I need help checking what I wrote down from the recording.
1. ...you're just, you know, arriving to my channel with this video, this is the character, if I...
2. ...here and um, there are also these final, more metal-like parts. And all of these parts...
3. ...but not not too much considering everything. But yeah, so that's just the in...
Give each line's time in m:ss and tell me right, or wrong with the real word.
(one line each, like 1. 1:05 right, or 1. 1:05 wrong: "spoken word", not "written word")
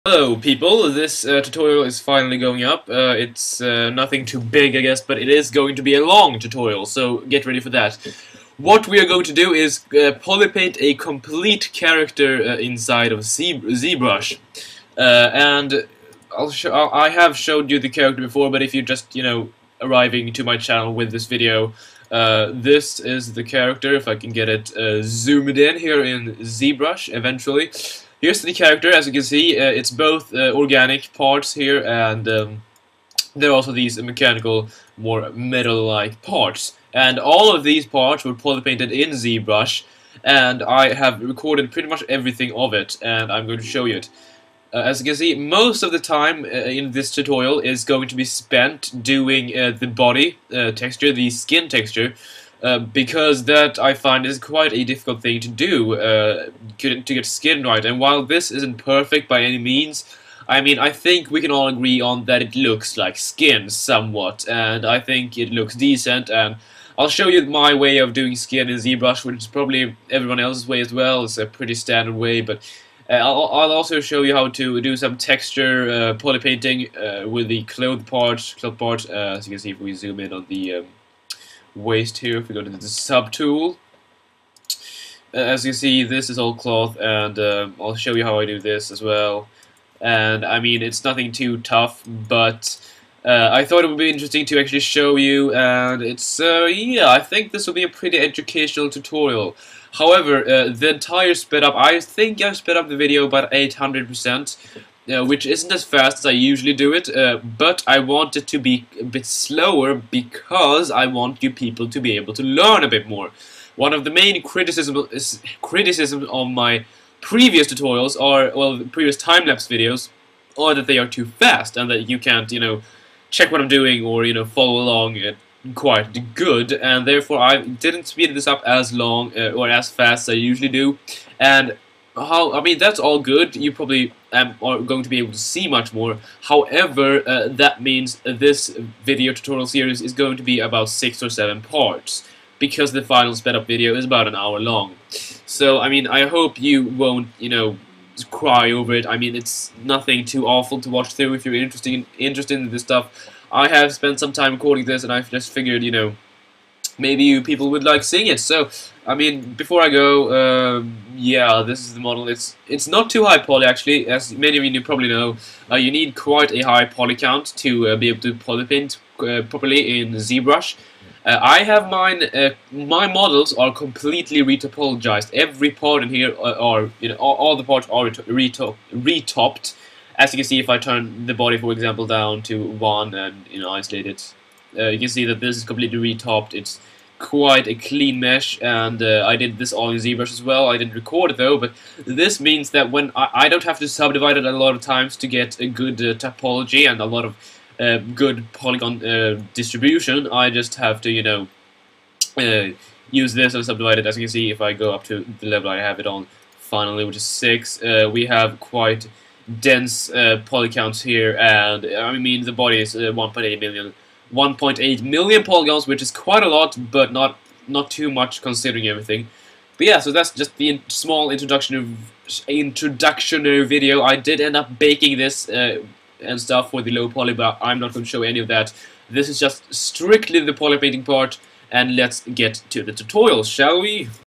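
1. 0:18 right
2. 0:31 wrong: "mechanical", not "final"
3. 3:36 right.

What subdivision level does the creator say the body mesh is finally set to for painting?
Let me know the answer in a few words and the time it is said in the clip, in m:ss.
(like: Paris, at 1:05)
6, at 3:27.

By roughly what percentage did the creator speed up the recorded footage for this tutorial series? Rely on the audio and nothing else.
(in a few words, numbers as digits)
800%.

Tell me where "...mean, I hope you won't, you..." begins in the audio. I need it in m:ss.
2:25.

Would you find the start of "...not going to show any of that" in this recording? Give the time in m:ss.
3:47.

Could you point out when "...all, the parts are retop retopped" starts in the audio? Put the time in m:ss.
2:57.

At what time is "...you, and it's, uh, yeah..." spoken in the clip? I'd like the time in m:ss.
1:35.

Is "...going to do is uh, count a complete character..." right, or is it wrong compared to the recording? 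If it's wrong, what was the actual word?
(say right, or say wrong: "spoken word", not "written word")
wrong: "polypaint", not "count".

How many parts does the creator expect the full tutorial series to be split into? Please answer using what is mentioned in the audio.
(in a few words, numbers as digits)
6 or 7.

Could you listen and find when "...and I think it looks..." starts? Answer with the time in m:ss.
1:04.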